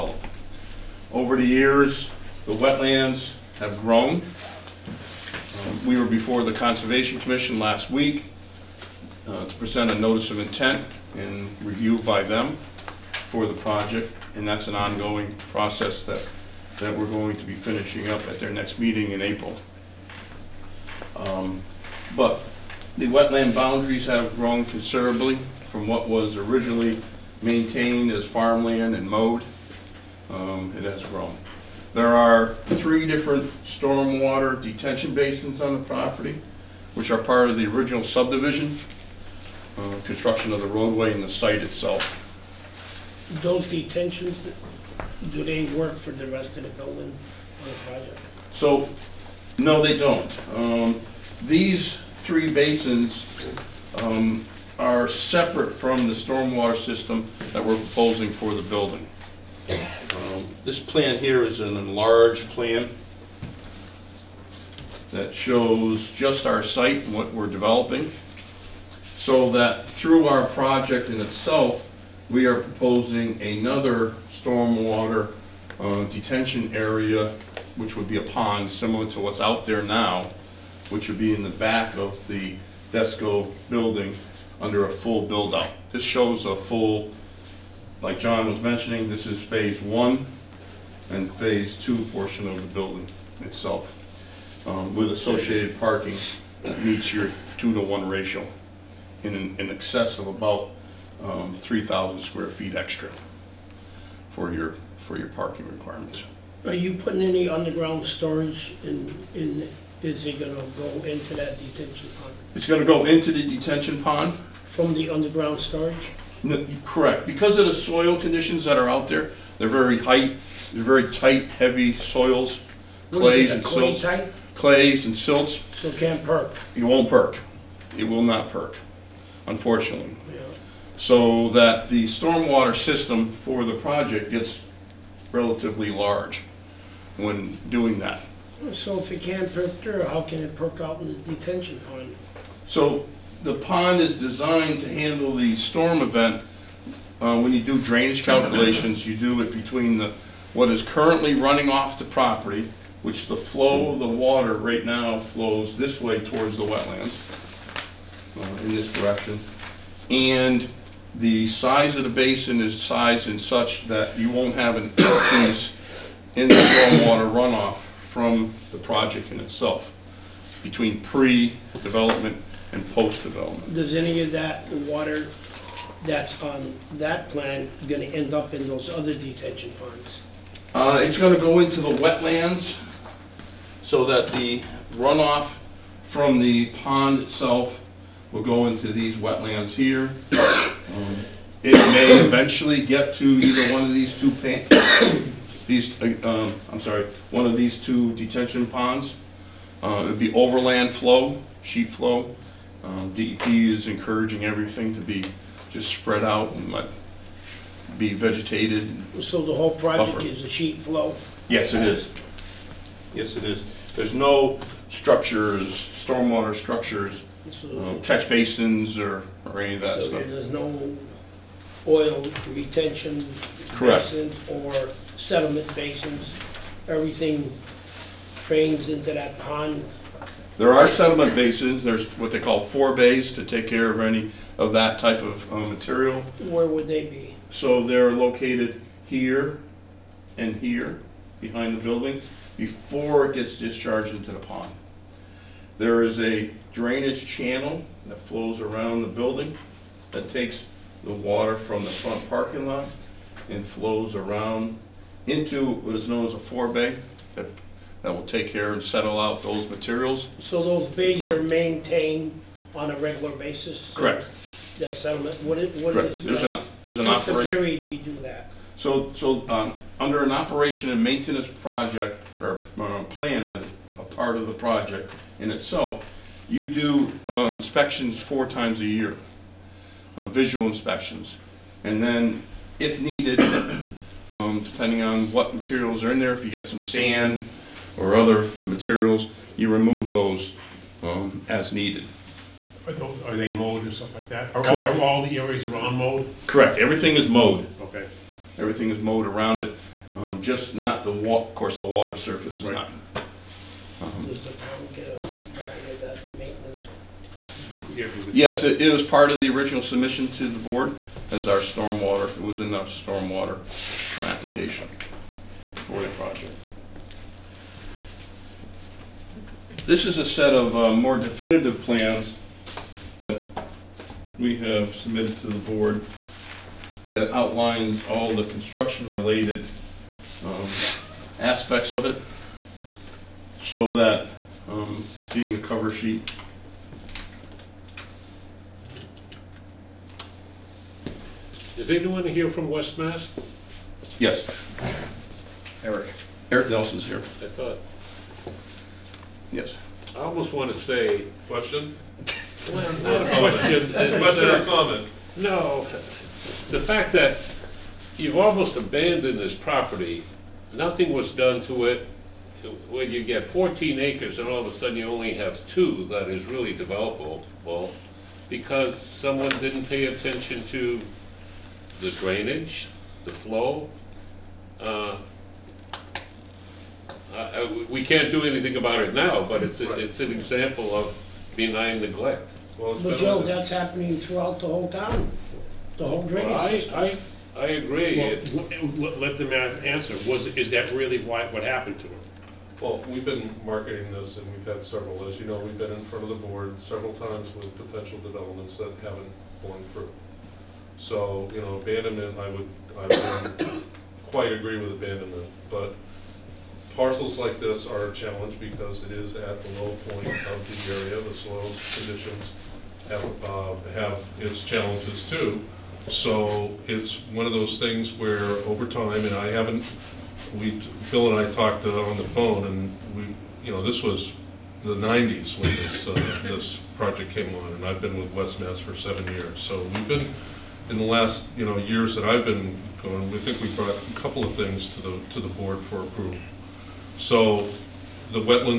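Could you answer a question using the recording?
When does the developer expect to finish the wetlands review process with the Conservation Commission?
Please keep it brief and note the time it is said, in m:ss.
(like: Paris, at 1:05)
April, at 0:19.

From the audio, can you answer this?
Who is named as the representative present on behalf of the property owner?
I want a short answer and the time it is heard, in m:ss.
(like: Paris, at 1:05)
Eric Nelson, at 5:46.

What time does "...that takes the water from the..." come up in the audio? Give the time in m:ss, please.
4:10.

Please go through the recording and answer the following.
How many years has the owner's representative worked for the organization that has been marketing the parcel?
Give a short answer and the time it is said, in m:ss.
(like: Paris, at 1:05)
7, at 7:08.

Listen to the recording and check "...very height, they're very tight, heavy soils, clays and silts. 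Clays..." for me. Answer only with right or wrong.
right.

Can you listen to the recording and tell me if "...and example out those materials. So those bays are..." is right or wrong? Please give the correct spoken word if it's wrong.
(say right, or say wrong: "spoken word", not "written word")
wrong: "settle", not "example".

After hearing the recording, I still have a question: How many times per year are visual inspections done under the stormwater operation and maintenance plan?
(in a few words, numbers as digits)
4.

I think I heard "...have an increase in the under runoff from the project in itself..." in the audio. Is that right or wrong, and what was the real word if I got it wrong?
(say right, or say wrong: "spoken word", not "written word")
wrong: "stormwater", not "under".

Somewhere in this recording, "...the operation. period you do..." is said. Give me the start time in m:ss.
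4:27.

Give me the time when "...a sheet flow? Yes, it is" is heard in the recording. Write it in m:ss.
3:30.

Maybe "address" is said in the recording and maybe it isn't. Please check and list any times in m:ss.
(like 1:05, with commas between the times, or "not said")
not said.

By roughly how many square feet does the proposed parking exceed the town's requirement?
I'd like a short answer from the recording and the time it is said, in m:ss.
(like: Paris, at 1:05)
3,000, at 1:41.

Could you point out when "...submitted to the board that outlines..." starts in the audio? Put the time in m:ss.
5:24.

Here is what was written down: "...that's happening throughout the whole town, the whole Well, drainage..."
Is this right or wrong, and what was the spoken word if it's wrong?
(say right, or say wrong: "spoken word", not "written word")
right.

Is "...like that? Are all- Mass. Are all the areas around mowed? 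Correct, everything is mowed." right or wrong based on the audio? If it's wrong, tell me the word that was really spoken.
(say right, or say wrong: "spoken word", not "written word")
wrong: "Correct", not "Mass".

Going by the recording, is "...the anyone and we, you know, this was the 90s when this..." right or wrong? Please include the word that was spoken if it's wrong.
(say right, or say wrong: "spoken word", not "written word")
wrong: "phone", not "anyone".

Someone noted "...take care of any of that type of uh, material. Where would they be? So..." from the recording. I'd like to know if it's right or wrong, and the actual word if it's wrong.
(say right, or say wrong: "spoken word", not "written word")
right.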